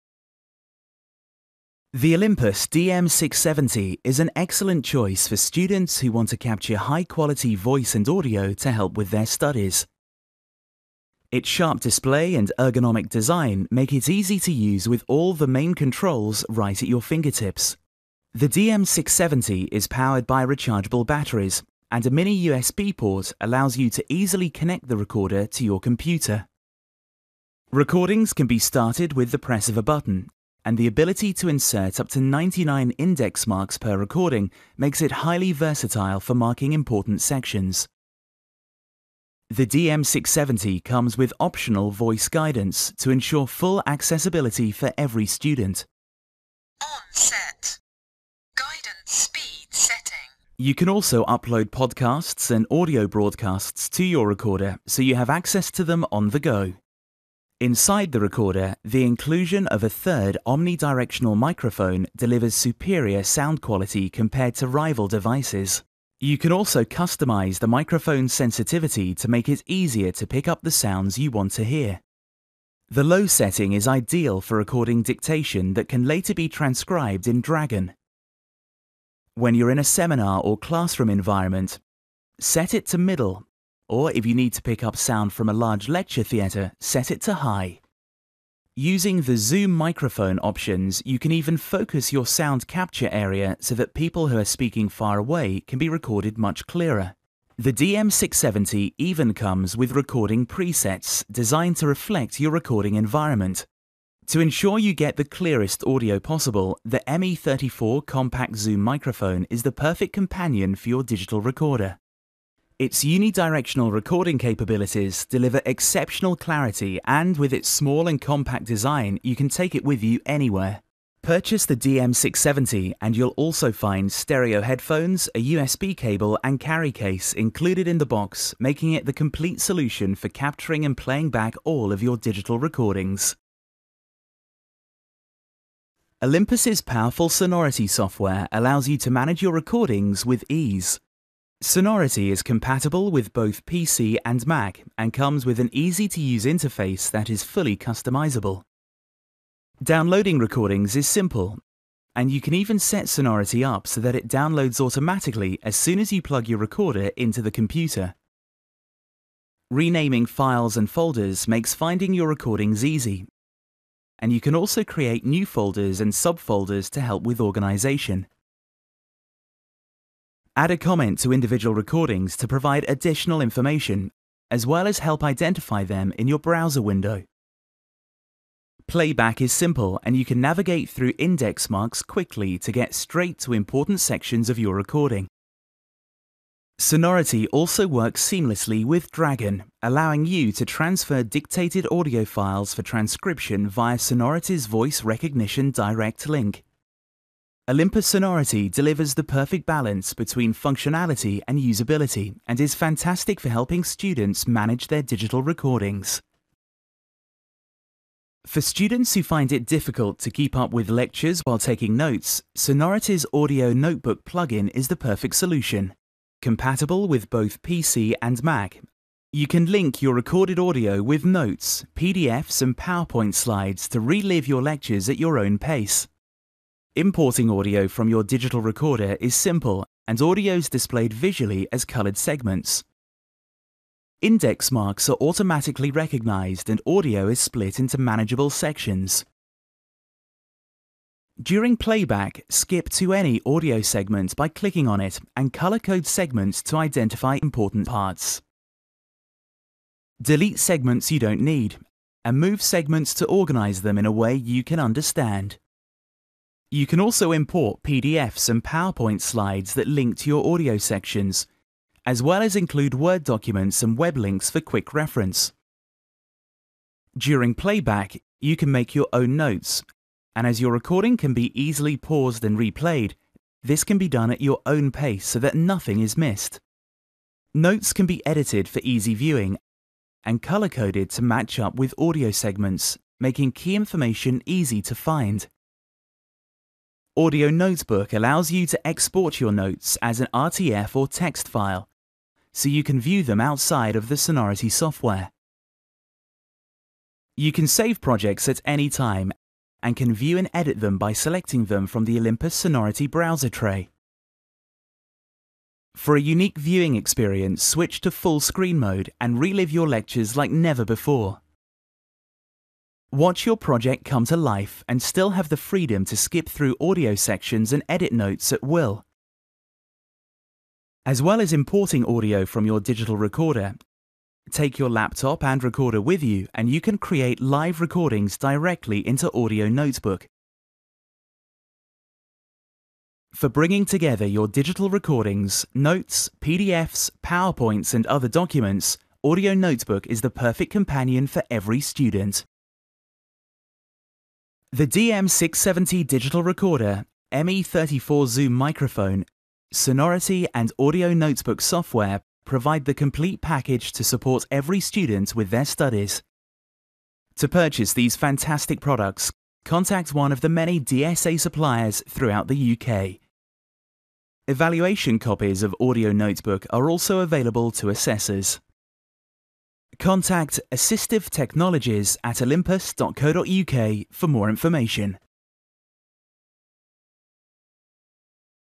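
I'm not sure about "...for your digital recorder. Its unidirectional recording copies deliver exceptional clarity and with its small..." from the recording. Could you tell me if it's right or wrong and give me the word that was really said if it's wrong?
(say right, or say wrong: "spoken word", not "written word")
wrong: "capabilities", not "copies".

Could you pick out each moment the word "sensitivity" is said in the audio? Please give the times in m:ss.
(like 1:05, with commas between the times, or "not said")
1:08.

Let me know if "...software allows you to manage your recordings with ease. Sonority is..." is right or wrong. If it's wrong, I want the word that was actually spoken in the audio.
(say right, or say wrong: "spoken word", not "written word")
right.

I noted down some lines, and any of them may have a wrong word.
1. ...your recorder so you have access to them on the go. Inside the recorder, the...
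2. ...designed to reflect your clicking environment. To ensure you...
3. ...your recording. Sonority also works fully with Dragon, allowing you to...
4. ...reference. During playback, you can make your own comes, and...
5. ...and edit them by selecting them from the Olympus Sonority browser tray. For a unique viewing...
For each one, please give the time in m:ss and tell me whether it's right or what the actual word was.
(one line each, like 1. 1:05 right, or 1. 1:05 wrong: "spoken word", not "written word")
1. 0:54 right
2. 1:41 wrong: "recording", not "clicking"
3. 3:04 wrong: "seamlessly", not "fully"
4. 4:24 wrong: "notes", not "comes"
5. 5:00 right.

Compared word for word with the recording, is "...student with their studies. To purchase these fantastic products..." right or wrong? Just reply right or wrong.
right.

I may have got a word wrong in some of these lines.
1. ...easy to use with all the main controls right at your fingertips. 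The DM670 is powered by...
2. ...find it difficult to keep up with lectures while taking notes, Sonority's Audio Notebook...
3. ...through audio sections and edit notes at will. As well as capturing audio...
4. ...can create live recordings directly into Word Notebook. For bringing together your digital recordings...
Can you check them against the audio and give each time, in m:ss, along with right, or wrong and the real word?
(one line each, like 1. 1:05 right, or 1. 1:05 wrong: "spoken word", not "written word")
1. 0:14 right
2. 3:29 right
3. 5:16 wrong: "importing", not "capturing"
4. 5:26 wrong: "Audio", not "Word".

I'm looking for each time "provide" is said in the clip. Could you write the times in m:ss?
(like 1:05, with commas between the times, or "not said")
2:52, 5:52.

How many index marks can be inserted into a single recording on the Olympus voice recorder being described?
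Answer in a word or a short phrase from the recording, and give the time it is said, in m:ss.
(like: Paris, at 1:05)
99, at 0:32.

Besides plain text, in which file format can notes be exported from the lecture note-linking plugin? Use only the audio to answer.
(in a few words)
RTF.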